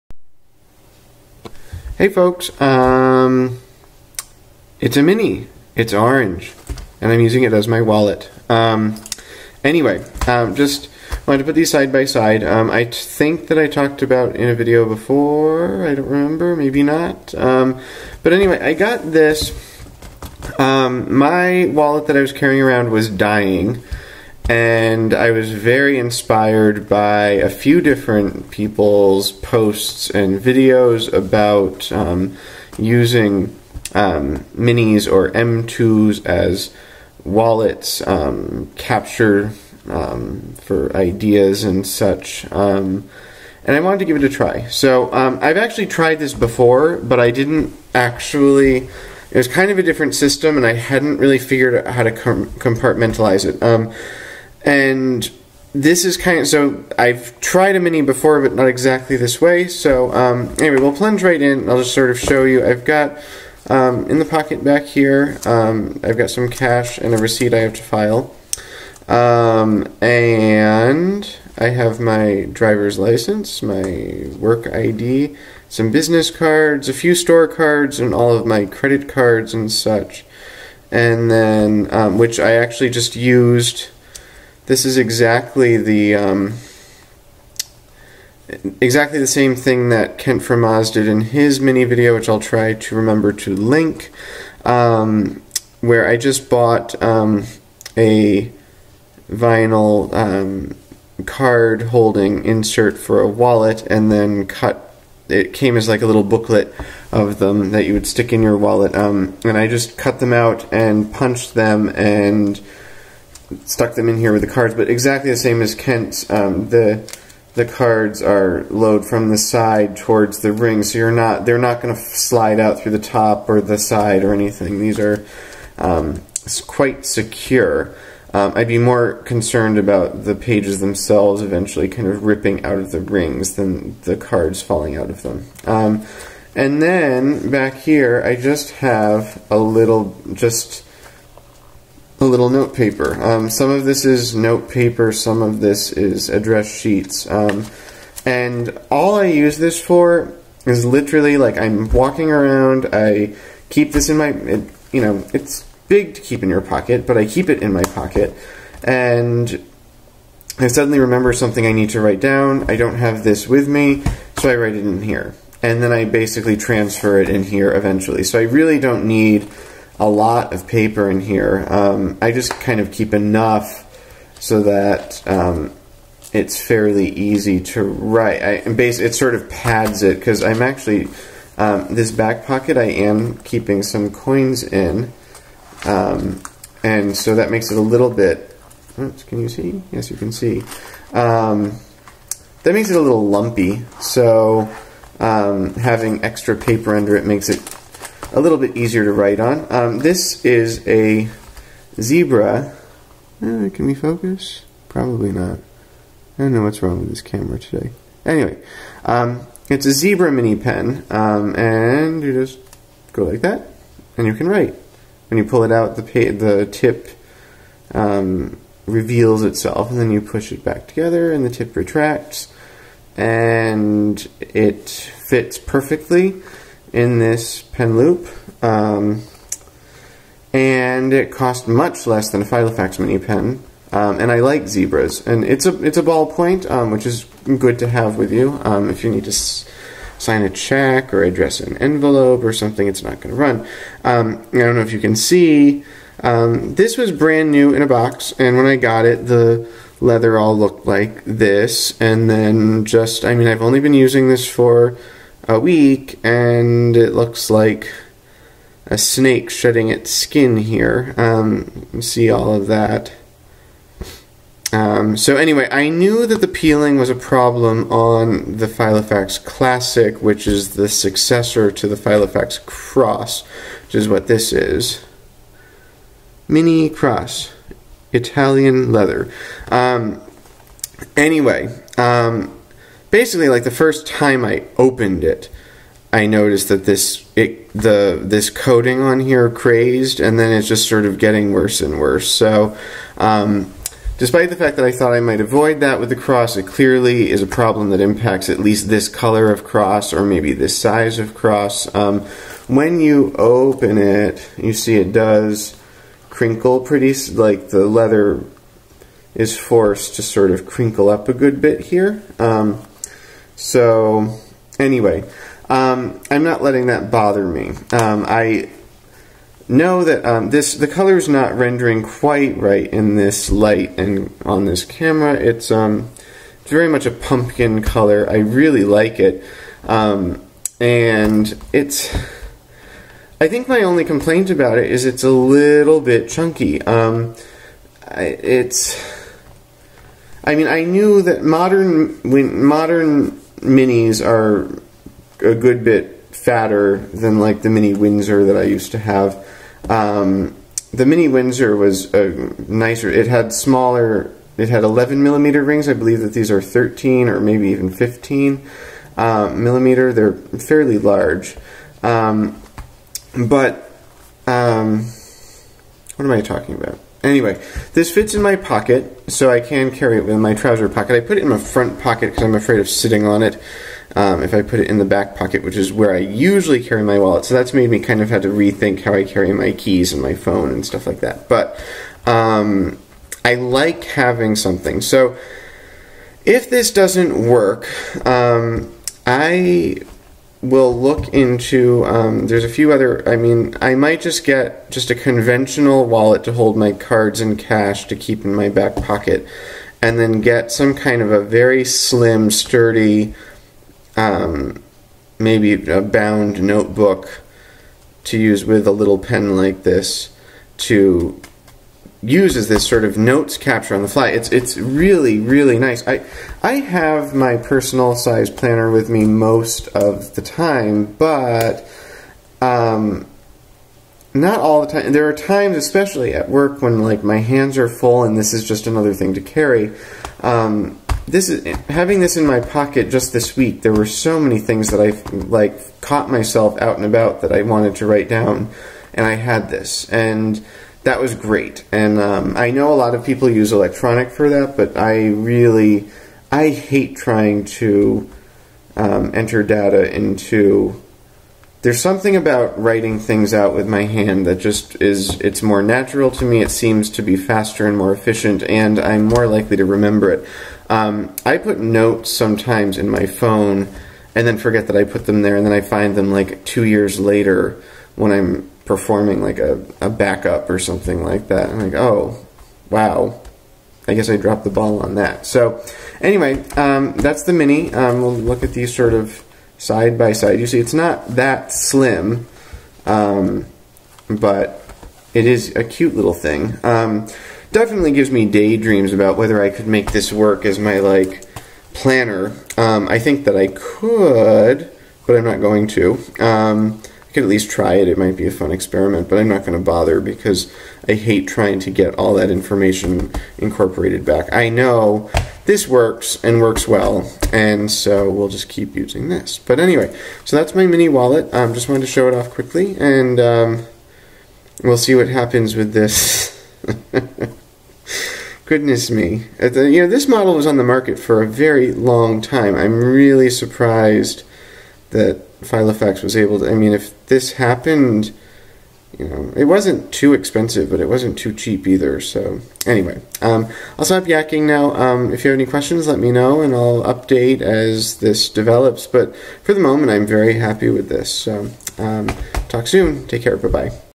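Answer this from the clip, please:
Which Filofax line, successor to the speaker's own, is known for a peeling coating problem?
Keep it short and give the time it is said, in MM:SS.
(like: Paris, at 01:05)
Filofax Classic, at 04:28.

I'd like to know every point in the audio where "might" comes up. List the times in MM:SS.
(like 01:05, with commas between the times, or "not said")
04:55, 06:33, 08:18.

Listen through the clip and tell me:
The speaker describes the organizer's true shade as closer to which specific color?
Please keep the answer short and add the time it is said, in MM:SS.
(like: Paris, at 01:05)
Pumpkin, at 05:27.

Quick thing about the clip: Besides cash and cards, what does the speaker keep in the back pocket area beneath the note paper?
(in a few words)
Coins.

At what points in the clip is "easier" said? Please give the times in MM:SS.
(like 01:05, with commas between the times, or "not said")
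03:18.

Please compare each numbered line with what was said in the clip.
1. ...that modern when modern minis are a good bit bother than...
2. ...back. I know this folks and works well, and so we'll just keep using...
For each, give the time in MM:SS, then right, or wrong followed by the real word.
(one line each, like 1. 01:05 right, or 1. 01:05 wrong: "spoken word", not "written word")
1. 05:41 wrong: "fatter", not "bother"
2. 08:24 wrong: "works", not "folks".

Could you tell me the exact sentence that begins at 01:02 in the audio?
I've got um, in the pocket back here.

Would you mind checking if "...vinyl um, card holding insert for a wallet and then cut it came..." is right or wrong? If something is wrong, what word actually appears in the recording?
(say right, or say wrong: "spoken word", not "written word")
right.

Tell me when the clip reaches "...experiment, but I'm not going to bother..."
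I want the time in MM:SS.
08:18.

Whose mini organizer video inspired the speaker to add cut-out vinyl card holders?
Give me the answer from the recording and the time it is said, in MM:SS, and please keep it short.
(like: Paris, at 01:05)
Kent from Oz, at 01:30.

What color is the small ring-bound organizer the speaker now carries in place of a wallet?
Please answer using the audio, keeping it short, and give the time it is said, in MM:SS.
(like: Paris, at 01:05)
Orange, at 00:05.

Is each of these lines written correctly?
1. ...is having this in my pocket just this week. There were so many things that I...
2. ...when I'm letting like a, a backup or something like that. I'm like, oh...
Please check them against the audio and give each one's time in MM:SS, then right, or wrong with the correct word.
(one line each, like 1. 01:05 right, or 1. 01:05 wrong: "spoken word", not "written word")
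1. 07:11 right
2. 07:48 wrong: "performing", not "letting".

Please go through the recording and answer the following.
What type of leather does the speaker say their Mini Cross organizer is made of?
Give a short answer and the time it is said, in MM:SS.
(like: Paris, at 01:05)
Italian leather, at 04:38.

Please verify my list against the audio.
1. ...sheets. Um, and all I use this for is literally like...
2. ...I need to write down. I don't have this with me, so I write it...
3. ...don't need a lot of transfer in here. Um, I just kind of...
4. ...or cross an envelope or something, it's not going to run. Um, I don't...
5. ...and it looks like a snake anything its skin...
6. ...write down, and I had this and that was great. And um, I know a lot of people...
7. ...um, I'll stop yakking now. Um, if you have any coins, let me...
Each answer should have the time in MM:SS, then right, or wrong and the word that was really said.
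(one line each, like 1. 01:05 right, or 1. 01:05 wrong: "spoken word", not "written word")
1. 02:26 right
2. 02:41 right
3. 02:48 wrong: "paper", not "transfer"
4. 04:01 wrong: "address", not "cross"
5. 04:16 wrong: "shedding", not "anything"
6. 07:18 right
7. 08:53 wrong: "questions", not "coins".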